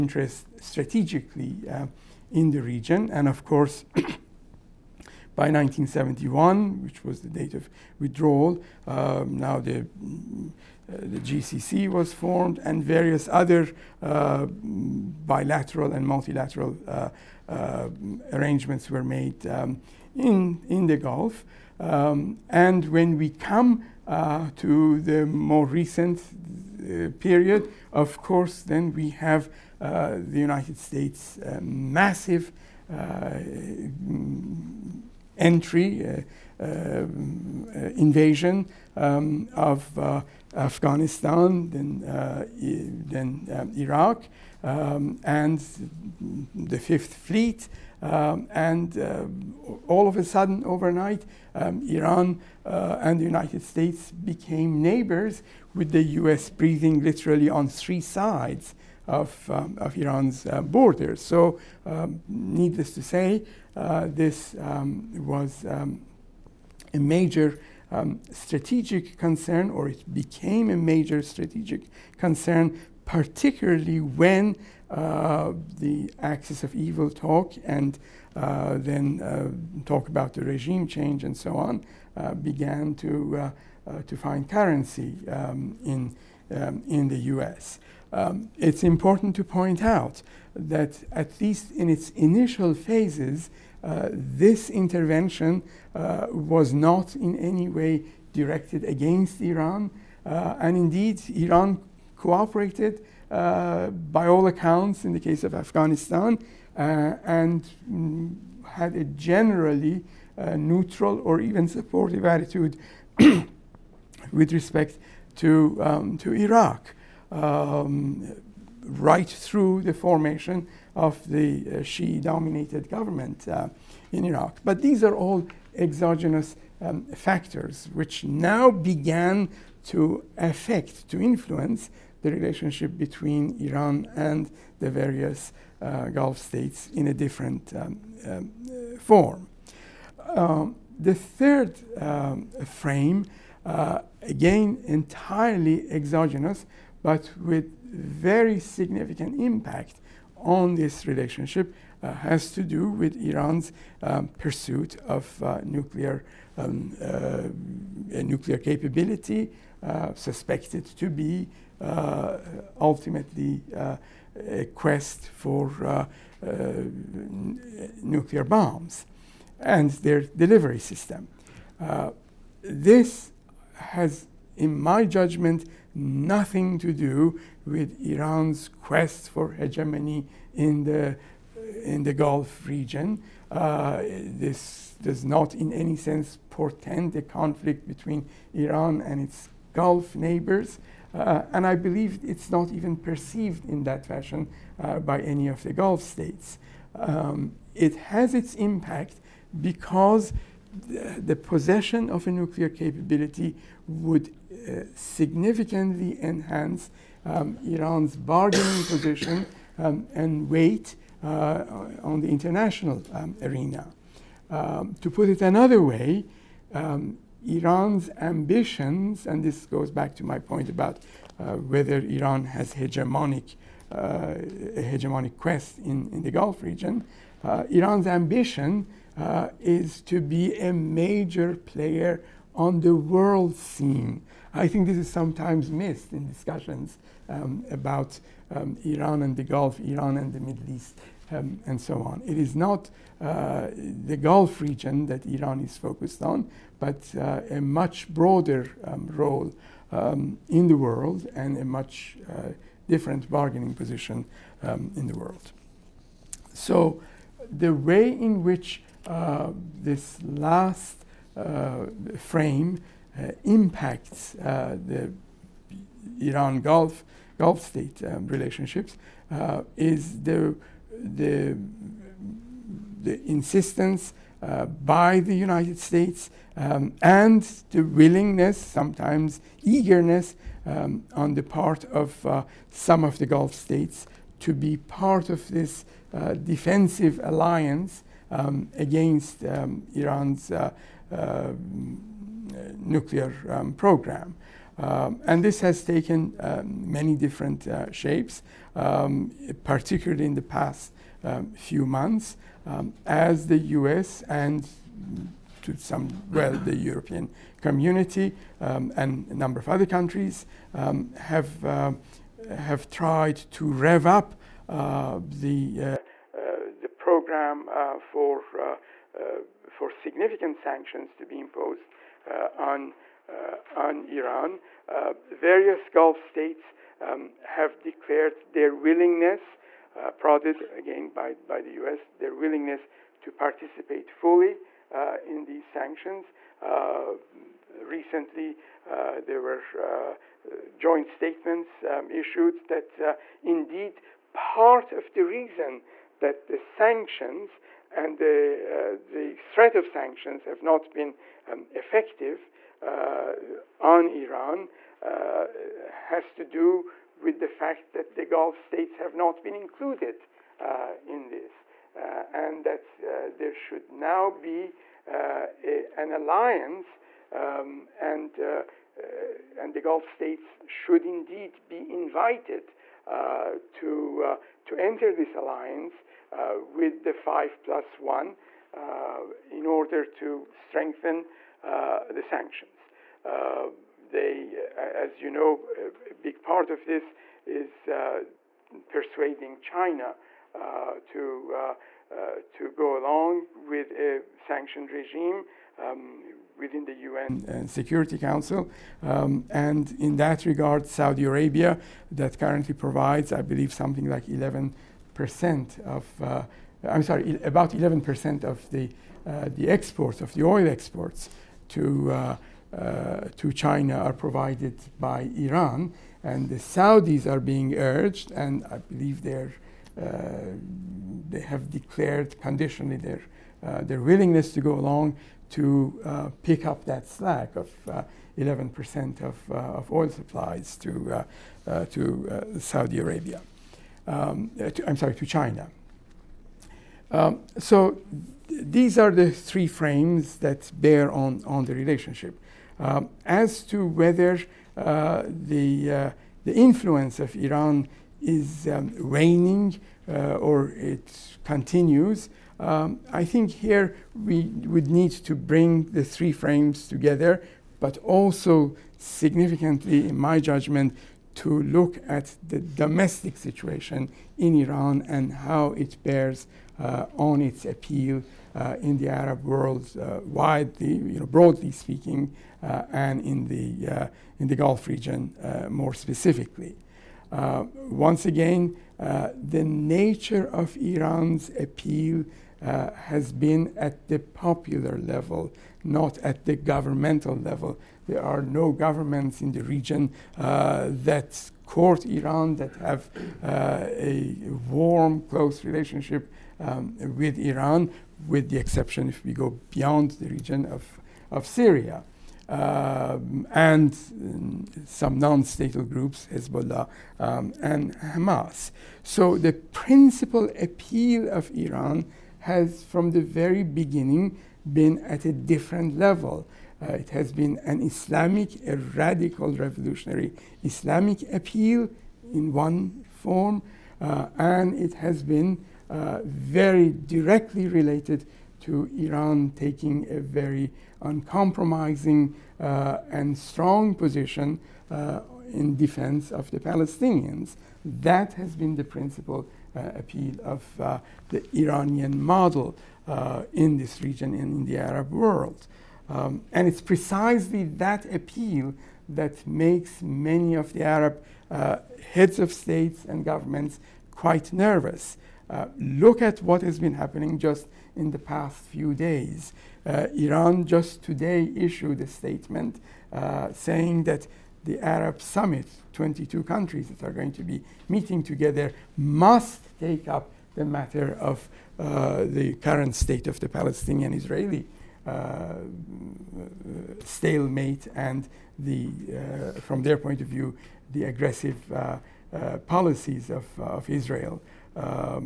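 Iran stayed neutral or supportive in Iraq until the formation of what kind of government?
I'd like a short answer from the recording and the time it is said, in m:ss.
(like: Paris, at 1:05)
Shia dominated government, at 2:01.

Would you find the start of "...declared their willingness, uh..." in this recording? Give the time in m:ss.
5:27.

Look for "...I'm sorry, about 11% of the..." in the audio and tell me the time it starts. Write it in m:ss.
6:46.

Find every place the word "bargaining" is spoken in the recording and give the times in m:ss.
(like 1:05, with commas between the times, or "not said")
3:28, 4:13.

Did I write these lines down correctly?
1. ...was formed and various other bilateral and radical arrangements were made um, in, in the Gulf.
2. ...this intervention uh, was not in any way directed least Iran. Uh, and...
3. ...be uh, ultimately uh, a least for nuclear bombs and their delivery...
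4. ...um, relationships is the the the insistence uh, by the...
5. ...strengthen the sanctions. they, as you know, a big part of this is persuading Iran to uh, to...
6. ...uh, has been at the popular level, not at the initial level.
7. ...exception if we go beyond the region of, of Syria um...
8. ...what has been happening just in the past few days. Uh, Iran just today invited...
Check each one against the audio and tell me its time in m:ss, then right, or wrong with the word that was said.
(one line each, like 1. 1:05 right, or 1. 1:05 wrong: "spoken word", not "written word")
1. 0:11 wrong: "multilateral", not "radical"
2. 1:34 wrong: "against", not "least"
3. 2:41 wrong: "quest", not "least"
4. 4:28 right
5. 6:20 wrong: "China", not "Iran"
6. 8:02 wrong: "governmental", not "initial"
7. 8:18 right
8. 9:16 wrong: "issued", not "invited".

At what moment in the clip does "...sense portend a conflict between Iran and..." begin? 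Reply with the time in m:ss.
3:05.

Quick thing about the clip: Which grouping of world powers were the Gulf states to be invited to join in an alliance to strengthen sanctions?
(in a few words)
5 plus 1.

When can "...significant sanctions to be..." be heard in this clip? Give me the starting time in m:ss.
5:19.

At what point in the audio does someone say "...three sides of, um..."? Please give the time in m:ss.
0:57.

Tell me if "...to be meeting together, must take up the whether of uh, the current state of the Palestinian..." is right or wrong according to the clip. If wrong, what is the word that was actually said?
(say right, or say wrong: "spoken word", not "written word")
wrong: "matter", not "whether".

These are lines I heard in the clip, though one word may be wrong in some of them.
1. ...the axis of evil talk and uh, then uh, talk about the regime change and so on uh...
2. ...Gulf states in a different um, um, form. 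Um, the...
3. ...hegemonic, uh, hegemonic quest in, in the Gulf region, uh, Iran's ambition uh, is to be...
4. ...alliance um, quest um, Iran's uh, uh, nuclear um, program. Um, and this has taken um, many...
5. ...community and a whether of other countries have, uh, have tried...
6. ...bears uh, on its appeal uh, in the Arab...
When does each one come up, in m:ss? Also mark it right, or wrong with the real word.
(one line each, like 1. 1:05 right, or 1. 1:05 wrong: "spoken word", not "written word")
1. 1:15 right
2. 2:16 right
3. 3:42 right
4. 4:47 wrong: "against", not "quest"
5. 5:07 wrong: "number", not "whether"
6. 7:46 right.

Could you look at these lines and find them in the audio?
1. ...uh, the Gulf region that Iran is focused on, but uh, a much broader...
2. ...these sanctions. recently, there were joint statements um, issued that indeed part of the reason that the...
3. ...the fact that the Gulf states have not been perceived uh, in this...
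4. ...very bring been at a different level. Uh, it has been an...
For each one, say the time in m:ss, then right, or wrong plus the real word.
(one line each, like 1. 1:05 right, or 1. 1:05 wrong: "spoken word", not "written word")
1. 4:03 right
2. 5:35 right
3. 5:57 wrong: "included", not "perceived"
4. 8:33 wrong: "beginning", not "bring".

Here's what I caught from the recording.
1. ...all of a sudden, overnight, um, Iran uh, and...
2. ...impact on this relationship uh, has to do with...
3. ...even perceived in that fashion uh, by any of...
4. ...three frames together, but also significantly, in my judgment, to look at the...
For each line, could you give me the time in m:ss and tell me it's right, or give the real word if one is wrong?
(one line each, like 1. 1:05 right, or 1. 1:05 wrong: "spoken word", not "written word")
1. 0:49 right
2. 2:29 right
3. 3:12 right
4. 7:36 right.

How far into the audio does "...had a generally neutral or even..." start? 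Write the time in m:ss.
1:48.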